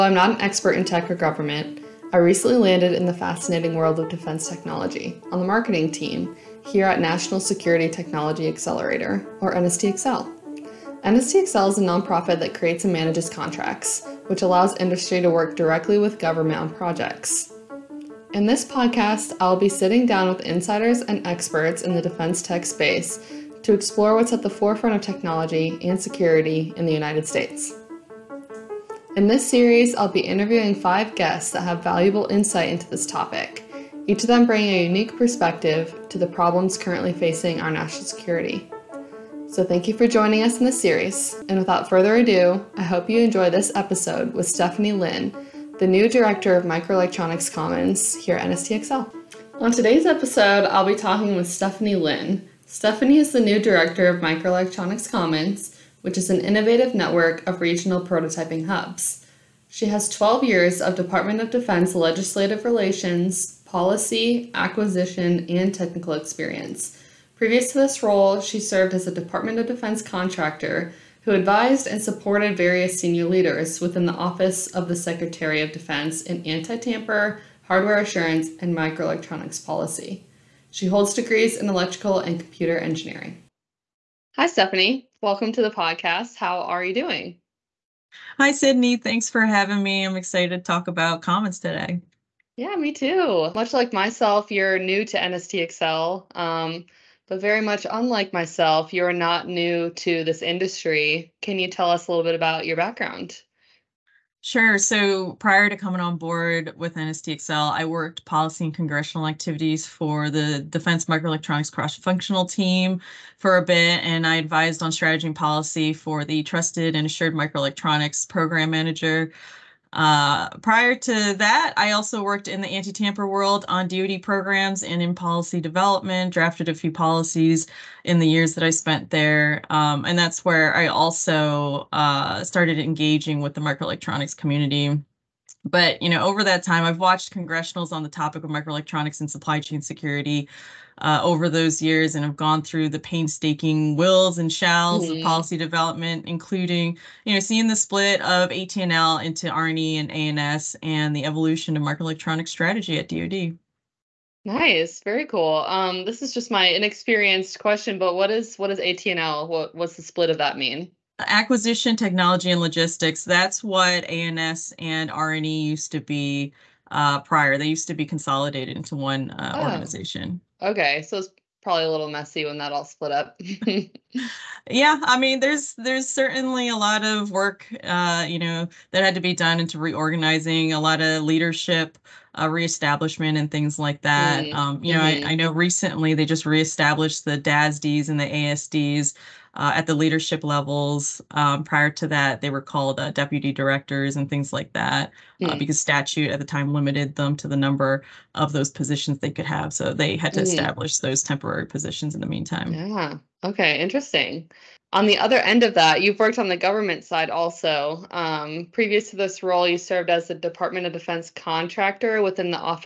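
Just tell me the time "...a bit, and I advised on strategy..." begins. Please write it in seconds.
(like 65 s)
113 s.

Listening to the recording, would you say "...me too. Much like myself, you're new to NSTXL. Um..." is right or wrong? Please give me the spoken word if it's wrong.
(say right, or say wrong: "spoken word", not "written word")
right.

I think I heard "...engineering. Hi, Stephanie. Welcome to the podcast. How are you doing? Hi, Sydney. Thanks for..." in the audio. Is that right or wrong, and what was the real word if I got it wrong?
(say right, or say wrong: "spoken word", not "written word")
right.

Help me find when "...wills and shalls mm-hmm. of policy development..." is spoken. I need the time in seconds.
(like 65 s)
143 s.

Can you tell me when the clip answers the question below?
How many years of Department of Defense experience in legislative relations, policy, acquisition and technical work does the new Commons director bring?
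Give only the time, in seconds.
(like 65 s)
60 s.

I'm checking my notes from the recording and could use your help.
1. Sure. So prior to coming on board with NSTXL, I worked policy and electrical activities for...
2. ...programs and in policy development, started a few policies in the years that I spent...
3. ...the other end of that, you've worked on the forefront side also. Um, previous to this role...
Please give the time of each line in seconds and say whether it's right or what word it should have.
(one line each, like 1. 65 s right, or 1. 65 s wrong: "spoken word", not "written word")
1. 104 s wrong: "congressional", not "electrical"
2. 124 s wrong: "drafted", not "started"
3. 205 s wrong: "government", not "forefront".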